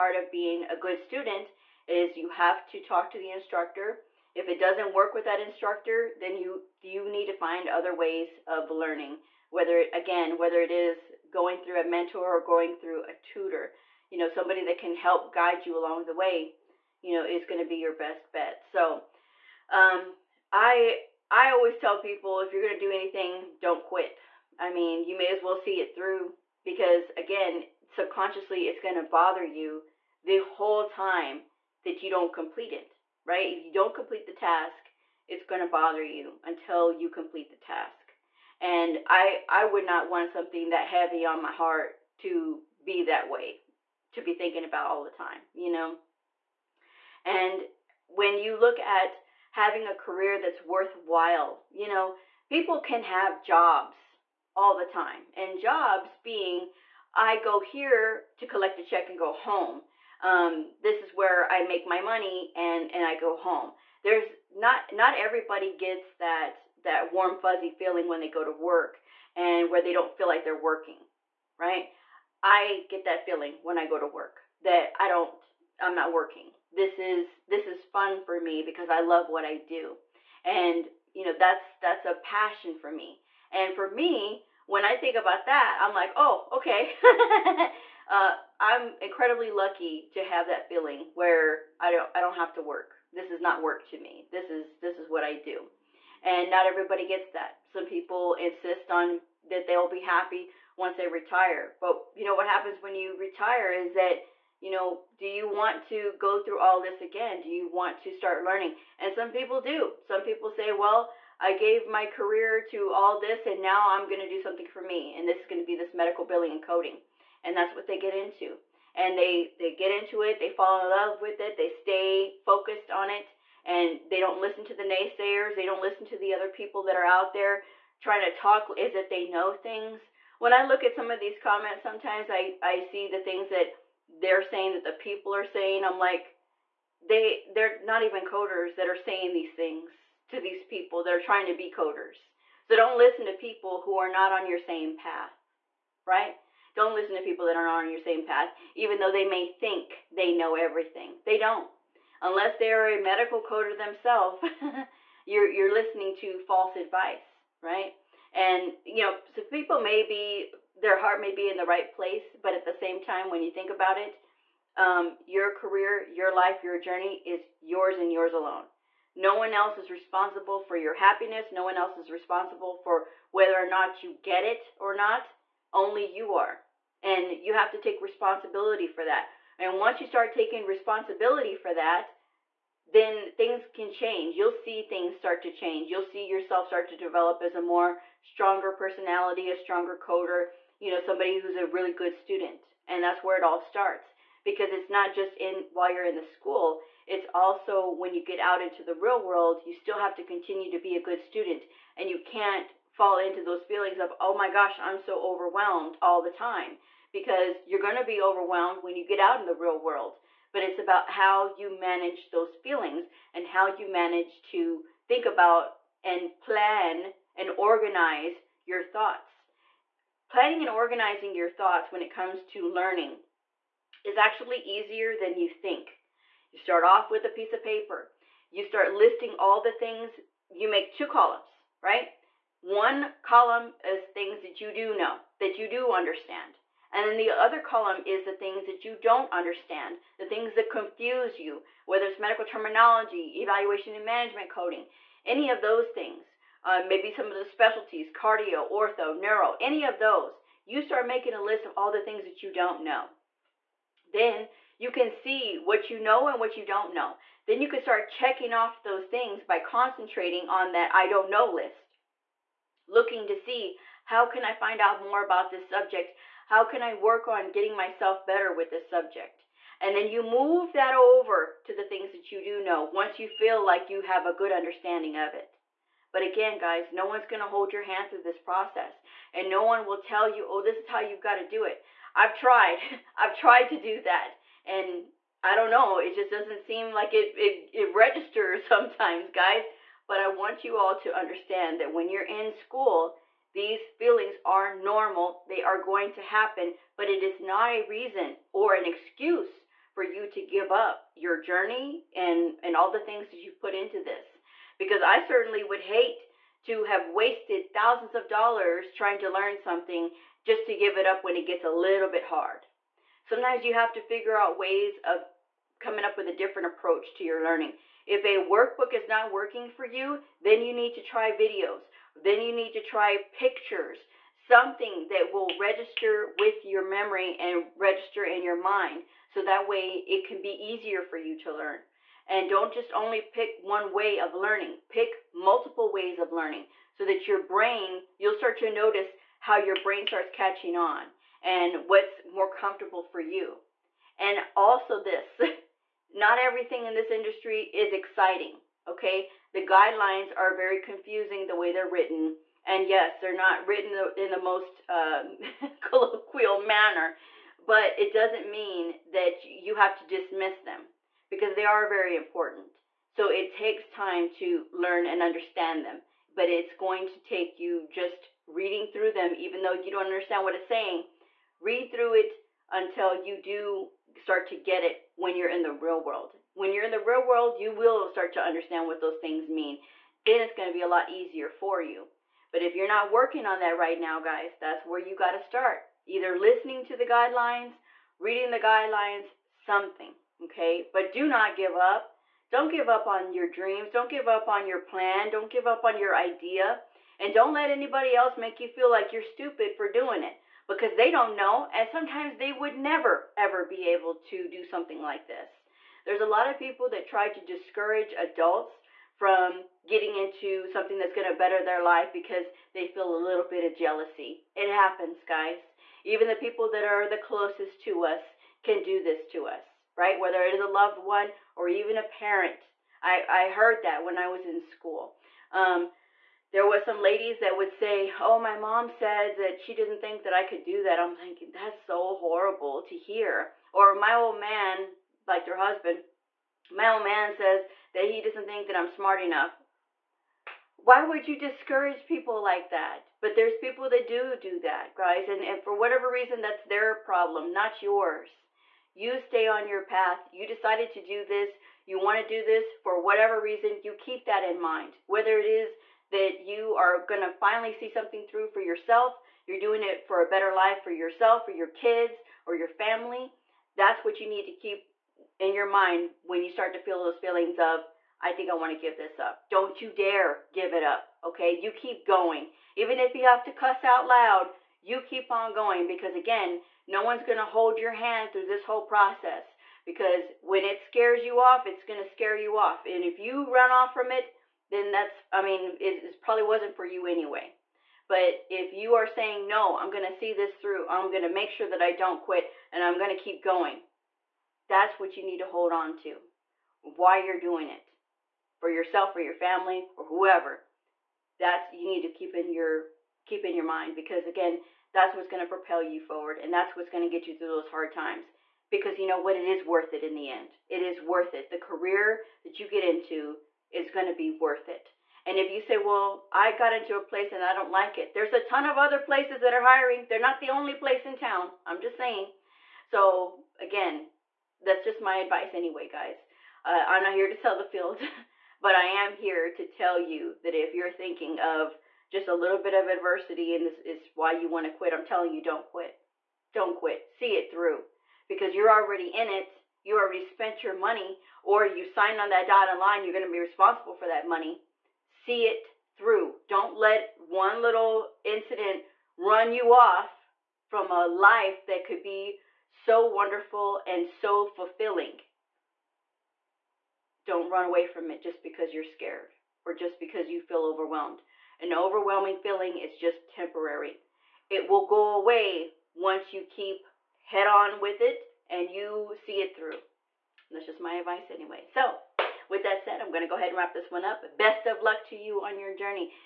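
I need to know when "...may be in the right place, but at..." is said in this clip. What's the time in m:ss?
2:41.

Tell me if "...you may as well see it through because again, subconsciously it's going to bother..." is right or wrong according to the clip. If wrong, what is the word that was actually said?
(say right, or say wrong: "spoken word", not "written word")
right.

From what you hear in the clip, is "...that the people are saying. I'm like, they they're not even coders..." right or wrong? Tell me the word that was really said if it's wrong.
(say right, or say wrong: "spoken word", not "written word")
right.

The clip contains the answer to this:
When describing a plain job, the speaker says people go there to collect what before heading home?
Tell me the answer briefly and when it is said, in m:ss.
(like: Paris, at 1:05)
A check, at 0:58.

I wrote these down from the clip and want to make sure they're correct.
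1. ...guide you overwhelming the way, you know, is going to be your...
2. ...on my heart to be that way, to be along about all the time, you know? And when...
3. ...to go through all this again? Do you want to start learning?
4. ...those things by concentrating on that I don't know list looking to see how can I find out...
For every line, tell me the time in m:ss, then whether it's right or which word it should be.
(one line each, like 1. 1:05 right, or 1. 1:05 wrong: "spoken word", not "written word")
1. 0:15 wrong: "along", not "overwhelming"
2. 0:41 wrong: "thinking", not "along"
3. 1:45 right
4. 4:18 right.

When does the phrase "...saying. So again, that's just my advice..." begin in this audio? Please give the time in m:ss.
8:41.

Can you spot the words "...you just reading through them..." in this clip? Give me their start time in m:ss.
6:07.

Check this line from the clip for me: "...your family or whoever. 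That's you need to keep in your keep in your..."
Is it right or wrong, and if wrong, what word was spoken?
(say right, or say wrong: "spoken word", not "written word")
right.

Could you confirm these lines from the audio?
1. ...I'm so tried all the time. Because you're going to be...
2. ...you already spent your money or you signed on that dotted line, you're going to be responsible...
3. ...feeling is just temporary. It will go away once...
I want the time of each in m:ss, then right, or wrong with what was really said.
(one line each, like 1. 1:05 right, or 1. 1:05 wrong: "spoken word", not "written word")
1. 3:24 wrong: "overwhelmed", not "tried"
2. 8:59 right
3. 9:22 right.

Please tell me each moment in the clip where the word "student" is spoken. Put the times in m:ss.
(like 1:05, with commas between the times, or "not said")
0:00, 3:12, 3:21.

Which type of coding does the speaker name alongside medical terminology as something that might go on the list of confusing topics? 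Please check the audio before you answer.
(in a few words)
Evaluation and management.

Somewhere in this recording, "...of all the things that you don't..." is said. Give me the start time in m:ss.
4:11.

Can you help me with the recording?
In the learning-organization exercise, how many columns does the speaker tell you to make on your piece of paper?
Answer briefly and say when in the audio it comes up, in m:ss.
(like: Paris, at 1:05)
2, at 3:50.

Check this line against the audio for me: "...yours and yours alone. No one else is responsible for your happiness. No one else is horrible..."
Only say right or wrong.
wrong.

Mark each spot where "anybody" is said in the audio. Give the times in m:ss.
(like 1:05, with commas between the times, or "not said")
6:37.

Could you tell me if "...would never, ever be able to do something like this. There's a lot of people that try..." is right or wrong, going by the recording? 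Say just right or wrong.
right.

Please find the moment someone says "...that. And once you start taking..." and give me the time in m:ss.
2:59.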